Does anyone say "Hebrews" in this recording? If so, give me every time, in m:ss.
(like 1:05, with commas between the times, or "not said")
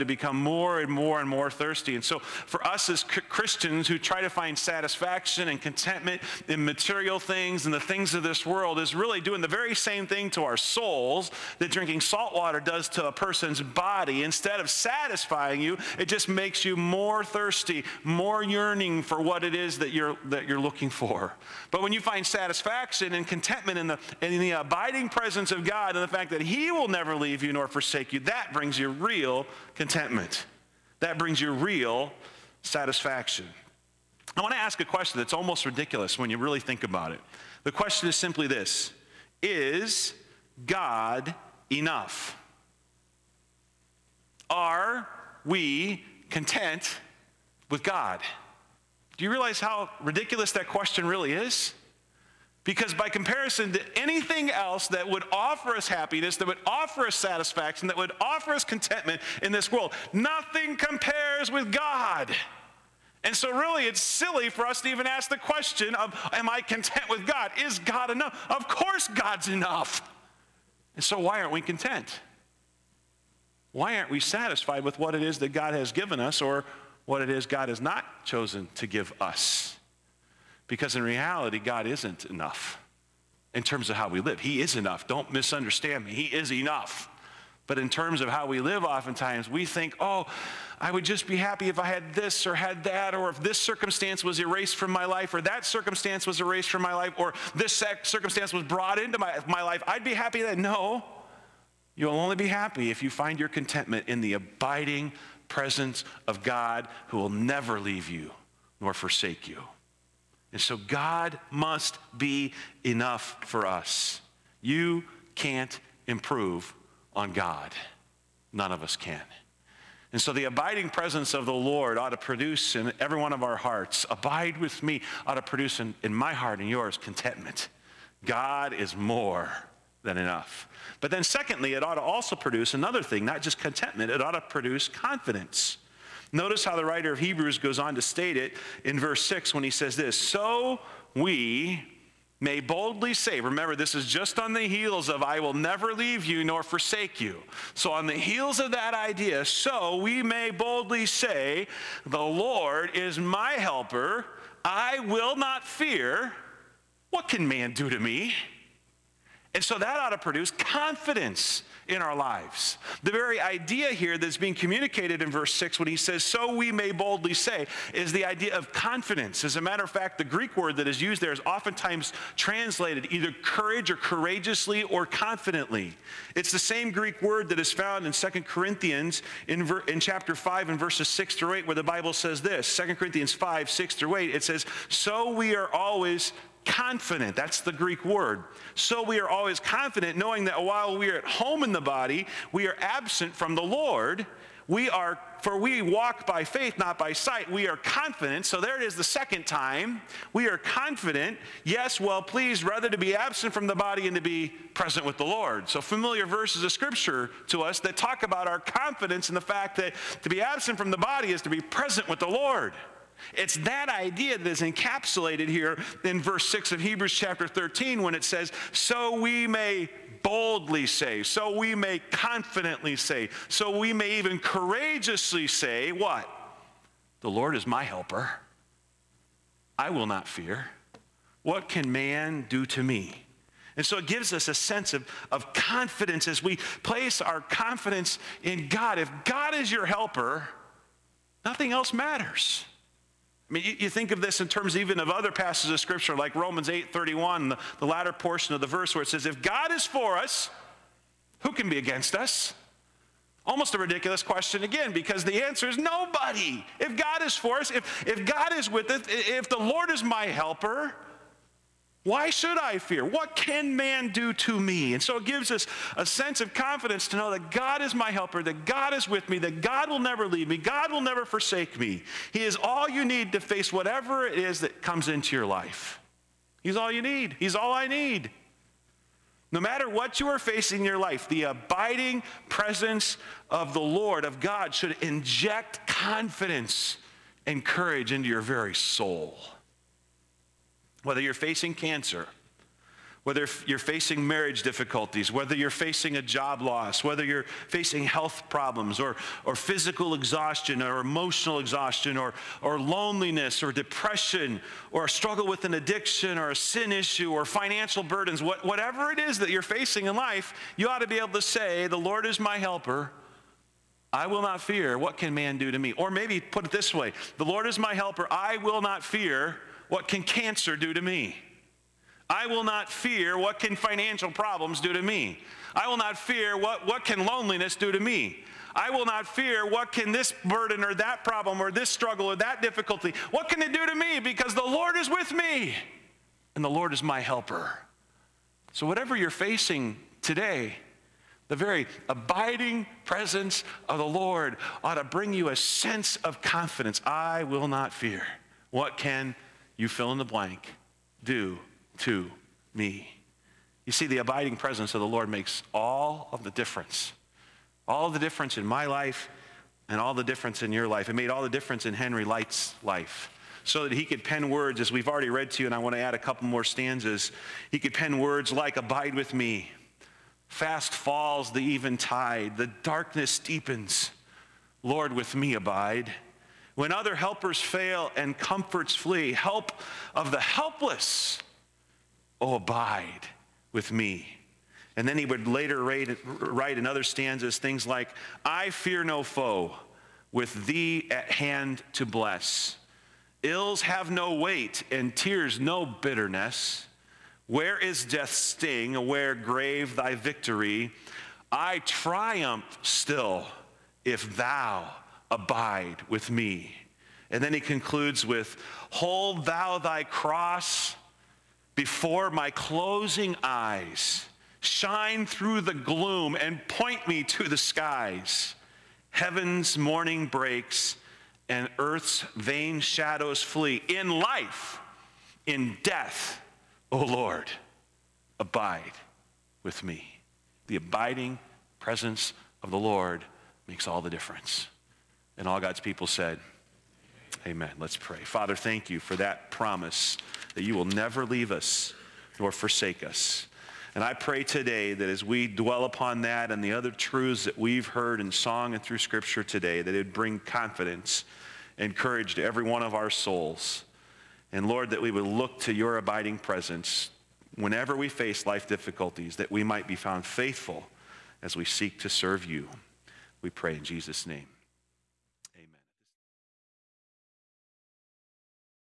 2:17, 3:36.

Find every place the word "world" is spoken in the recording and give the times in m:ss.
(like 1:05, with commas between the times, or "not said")
0:08, 0:59.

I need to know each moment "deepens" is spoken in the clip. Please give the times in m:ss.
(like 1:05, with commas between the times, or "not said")
6:13.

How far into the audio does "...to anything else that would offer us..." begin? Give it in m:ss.
0:53.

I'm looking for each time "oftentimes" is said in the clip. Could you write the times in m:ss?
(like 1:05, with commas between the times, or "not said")
1:28, 2:51.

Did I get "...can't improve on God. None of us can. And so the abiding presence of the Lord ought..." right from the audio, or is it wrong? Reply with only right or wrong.
right.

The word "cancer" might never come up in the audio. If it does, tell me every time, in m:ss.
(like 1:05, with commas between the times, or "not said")
4:51, 5:20.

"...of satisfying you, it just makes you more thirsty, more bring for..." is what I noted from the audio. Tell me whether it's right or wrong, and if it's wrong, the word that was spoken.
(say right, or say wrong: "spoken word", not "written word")
wrong: "yearning", not "bring".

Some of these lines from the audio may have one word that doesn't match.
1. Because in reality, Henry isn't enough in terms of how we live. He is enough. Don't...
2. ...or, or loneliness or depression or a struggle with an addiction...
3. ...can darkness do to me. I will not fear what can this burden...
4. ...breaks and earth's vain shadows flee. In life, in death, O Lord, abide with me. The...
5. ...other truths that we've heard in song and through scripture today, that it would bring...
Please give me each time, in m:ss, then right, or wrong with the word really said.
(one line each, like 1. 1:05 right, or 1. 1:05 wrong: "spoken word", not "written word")
1. 1:20 wrong: "God", not "Henry"
2. 5:02 right
3. 5:27 wrong: "loneliness", not "darkness"
4. 7:00 right
5. 7:26 right.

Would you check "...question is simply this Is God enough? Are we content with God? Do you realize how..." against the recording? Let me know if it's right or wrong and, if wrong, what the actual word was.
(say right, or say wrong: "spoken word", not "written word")
right.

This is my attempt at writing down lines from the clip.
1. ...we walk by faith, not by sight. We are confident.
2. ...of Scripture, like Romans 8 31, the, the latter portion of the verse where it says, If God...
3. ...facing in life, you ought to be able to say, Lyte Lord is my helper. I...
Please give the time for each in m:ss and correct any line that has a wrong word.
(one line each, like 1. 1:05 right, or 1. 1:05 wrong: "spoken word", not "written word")
1. 3:15 right
2. 4:05 right
3. 5:09 wrong: "The", not "Lyte".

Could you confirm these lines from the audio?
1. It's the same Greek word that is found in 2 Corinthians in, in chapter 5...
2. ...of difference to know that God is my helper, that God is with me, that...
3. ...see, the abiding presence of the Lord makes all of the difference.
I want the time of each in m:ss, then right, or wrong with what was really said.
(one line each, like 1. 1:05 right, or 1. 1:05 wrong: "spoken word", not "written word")
1. 2:56 right
2. 4:26 wrong: "confidence", not "difference"
3. 5:53 right.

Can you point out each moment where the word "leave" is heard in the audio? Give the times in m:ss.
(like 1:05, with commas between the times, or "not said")
0:27, 1:47, 2:25, 4:30, 7:21.